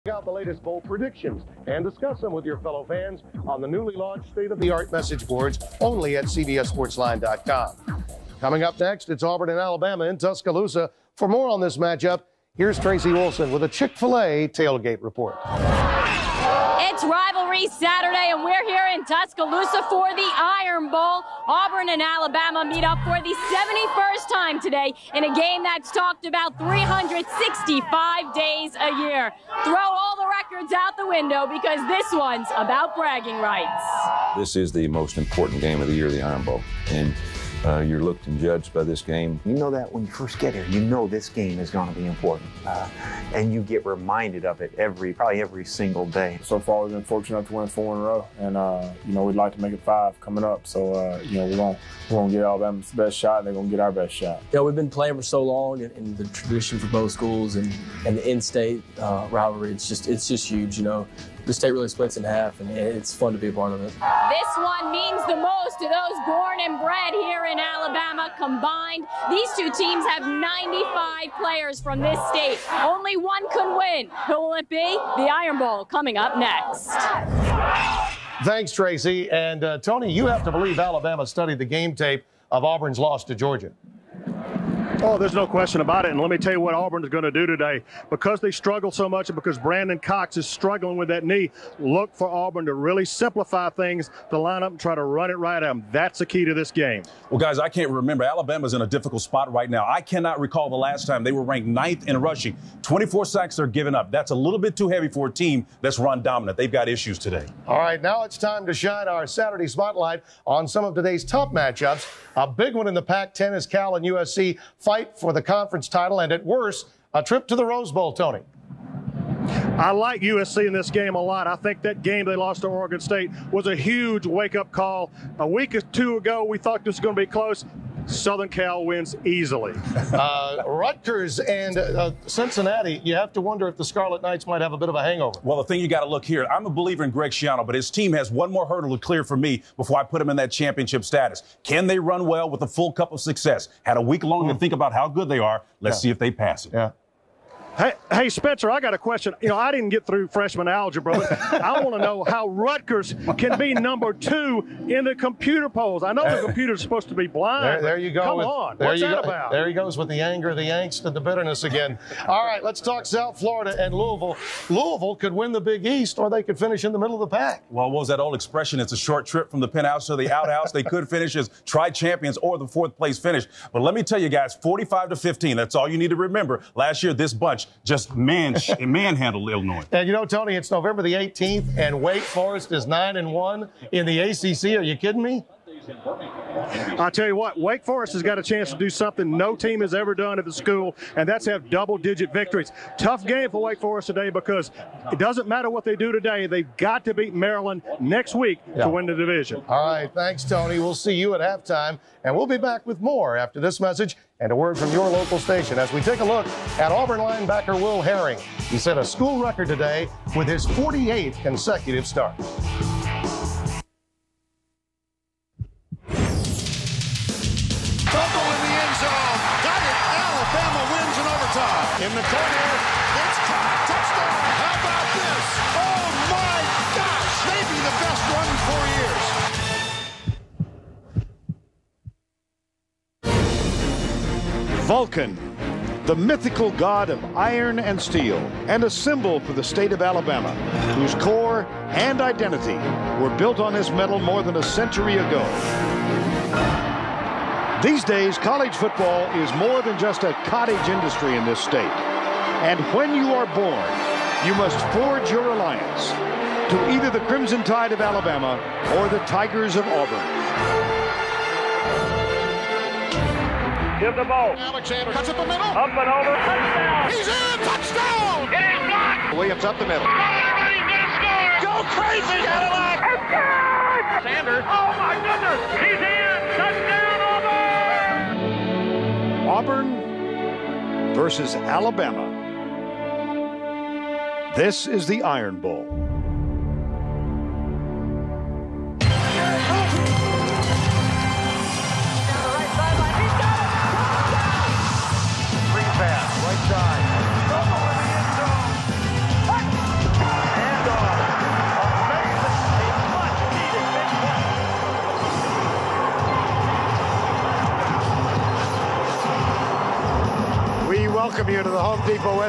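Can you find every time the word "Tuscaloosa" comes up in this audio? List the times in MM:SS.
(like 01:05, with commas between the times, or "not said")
00:10, 00:19.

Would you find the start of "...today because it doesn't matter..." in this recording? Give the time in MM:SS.
03:14.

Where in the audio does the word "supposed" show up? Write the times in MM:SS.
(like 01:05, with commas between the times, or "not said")
02:36.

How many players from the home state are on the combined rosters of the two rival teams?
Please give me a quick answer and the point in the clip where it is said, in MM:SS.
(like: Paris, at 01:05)
95, at 01:10.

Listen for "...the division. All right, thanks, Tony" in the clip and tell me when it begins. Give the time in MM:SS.
03:19.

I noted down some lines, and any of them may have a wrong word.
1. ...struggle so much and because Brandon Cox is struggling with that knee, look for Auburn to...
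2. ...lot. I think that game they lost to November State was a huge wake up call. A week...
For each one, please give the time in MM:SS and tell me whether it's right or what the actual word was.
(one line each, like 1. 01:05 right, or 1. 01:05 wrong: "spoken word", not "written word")
1. 01:28 right
2. 02:01 wrong: "Oregon", not "November".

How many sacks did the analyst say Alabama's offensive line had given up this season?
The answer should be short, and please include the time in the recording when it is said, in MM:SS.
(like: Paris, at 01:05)
24, at 01:42.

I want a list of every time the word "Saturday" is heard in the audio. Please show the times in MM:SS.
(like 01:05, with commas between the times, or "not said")
00:17, 01:49.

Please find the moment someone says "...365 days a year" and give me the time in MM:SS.
00:26.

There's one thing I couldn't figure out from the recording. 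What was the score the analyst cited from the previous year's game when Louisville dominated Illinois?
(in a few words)
45 to 15.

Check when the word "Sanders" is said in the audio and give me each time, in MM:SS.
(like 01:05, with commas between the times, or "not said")
04:34.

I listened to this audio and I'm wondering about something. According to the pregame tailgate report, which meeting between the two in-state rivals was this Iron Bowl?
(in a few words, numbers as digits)
71st.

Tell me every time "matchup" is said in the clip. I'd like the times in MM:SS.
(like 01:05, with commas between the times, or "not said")
00:11, 01:51.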